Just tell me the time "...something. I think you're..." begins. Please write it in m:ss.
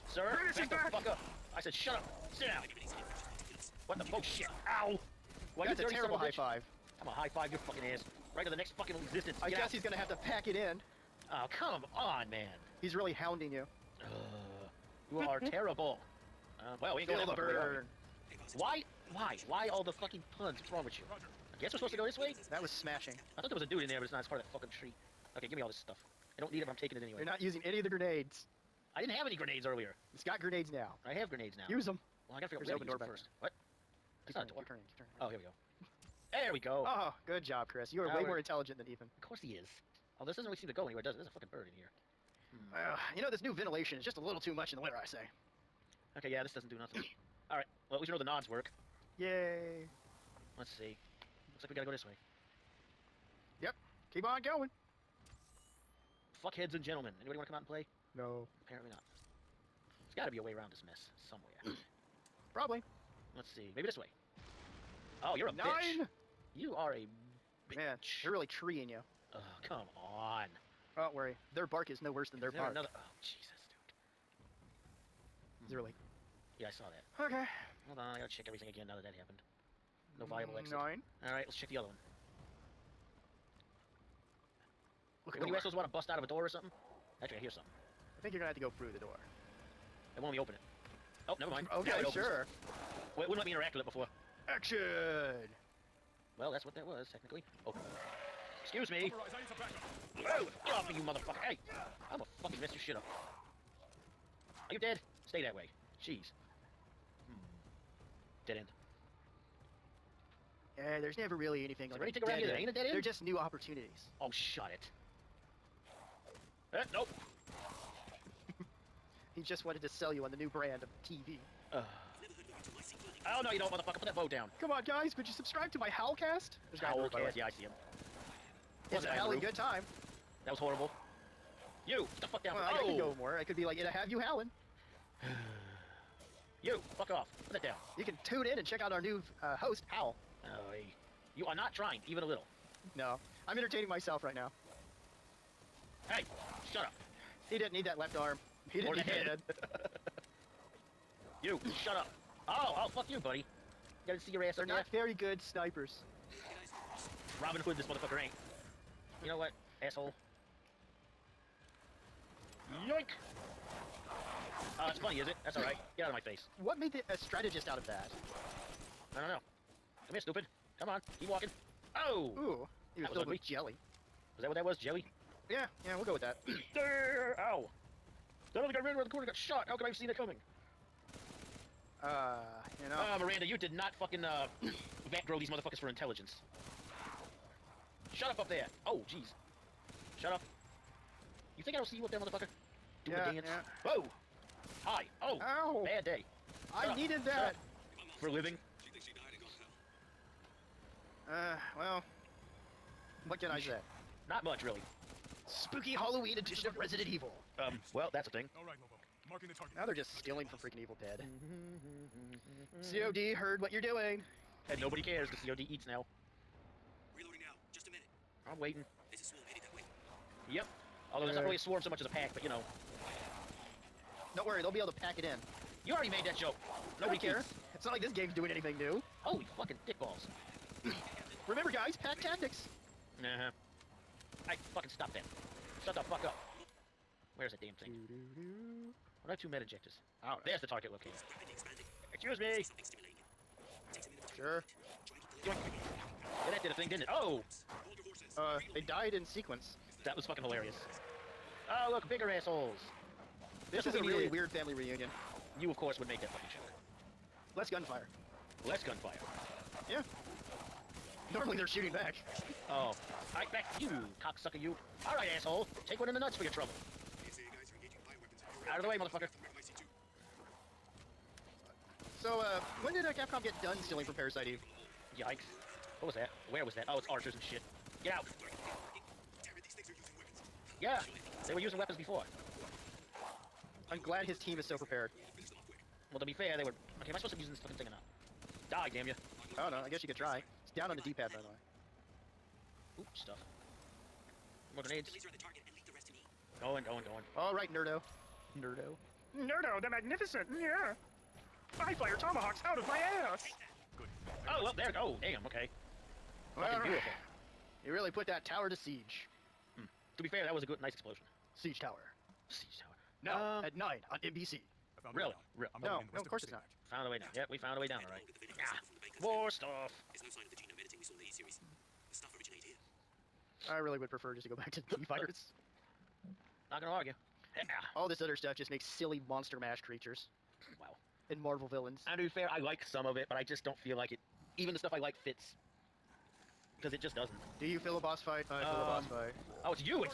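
1:27.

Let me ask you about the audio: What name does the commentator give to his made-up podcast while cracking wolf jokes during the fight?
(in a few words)
Howlcast.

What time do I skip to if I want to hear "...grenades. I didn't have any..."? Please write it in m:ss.
0:27.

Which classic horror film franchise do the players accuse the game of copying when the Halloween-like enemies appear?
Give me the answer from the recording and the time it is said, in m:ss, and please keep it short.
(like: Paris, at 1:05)
Evil Dead, at 3:30.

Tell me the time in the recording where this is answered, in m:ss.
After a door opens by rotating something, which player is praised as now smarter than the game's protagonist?
0:37.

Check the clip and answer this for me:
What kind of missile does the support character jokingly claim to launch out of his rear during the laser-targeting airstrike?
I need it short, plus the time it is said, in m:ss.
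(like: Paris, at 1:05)
Tomahawks, at 5:02.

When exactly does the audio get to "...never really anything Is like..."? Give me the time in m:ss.
1:51.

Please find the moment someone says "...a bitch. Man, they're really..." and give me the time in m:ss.
1:06.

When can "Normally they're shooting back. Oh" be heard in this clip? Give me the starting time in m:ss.
4:21.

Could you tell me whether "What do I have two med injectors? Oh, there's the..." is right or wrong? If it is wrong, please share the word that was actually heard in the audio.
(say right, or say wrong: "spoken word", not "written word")
right.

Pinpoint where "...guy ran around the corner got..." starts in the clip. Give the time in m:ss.
2:58.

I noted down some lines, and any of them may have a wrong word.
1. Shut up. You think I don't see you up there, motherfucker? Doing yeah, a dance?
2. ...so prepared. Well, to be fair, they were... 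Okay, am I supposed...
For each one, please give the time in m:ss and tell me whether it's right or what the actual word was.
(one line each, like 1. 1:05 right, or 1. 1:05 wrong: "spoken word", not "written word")
1. 3:10 right
2. 4:44 right.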